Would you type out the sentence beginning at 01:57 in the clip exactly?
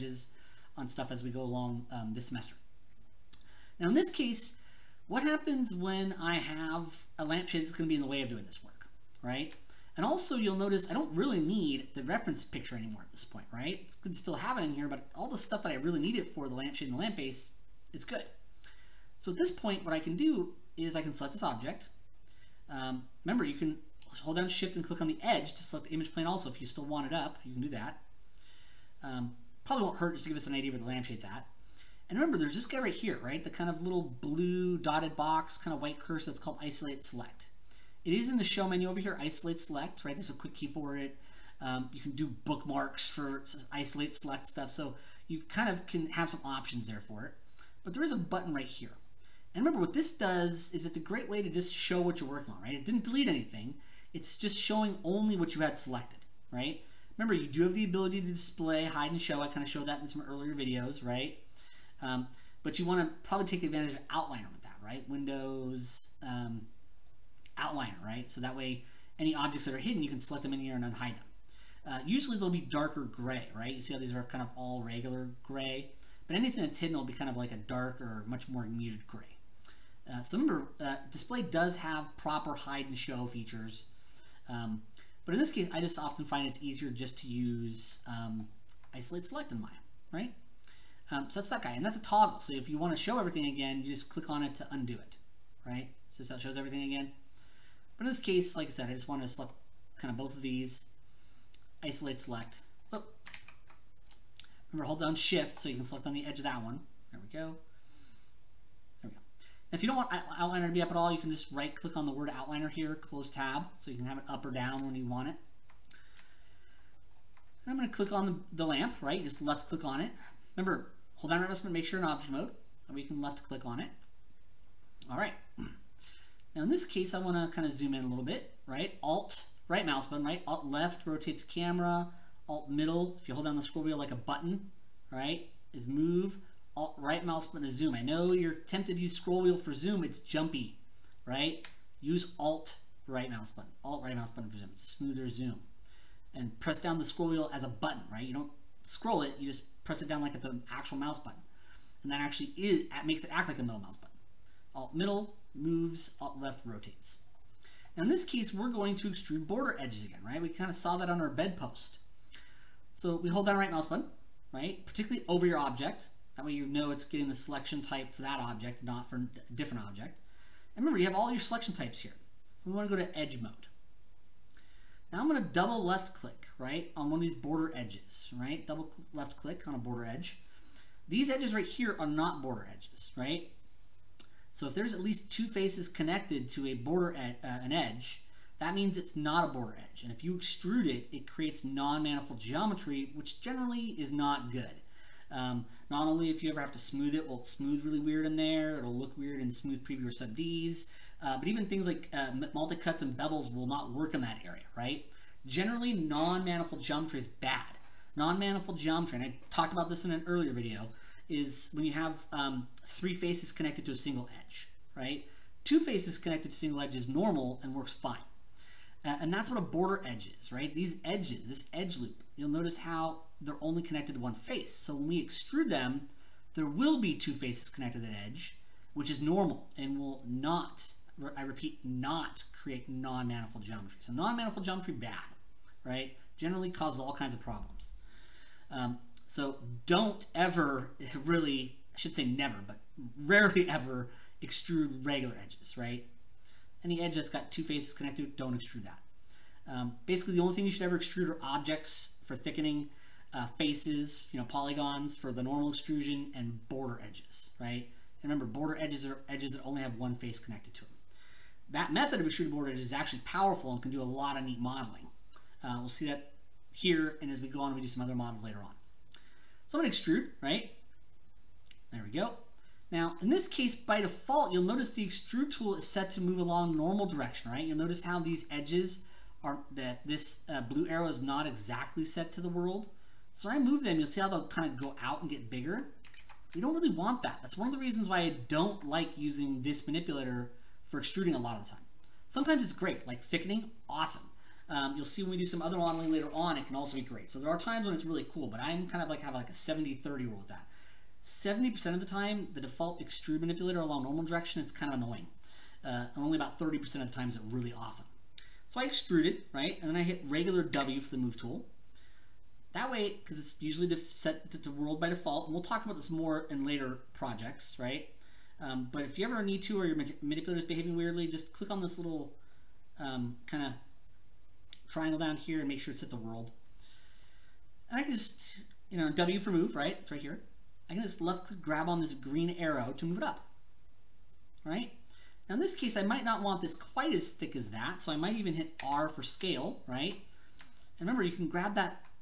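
And I'm going to click on the, the lamp, right?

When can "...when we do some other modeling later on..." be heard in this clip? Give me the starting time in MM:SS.
04:55.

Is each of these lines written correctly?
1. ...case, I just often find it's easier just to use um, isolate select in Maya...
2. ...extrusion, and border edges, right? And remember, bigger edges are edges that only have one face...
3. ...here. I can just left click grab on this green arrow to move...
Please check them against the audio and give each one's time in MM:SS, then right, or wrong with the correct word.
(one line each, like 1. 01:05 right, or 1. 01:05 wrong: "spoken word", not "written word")
1. 01:25 right
2. 04:15 wrong: "border", not "bigger"
3. 05:30 right.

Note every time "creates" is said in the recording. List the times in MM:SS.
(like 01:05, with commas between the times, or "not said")
03:11, 03:52.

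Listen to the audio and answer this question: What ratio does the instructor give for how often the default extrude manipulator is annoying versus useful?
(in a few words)
70-30.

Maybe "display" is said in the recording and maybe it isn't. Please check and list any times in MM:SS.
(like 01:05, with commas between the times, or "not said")
00:58, 01:21.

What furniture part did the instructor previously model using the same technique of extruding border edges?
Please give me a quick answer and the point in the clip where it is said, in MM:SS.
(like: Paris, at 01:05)
Bed post, at 02:41.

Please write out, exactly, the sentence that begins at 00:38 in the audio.
It is in the show menu over here, isolate select, right?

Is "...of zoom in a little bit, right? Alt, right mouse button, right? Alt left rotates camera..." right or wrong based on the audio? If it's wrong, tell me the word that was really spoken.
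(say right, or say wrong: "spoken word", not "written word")
right.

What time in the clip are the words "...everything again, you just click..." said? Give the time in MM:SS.
01:33.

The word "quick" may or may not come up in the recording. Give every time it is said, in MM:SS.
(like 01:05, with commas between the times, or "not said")
00:40.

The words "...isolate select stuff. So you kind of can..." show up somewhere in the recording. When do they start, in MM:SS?
00:43.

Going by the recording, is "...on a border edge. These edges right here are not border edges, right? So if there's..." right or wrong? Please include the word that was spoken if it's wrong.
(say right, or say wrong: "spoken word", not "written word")
right.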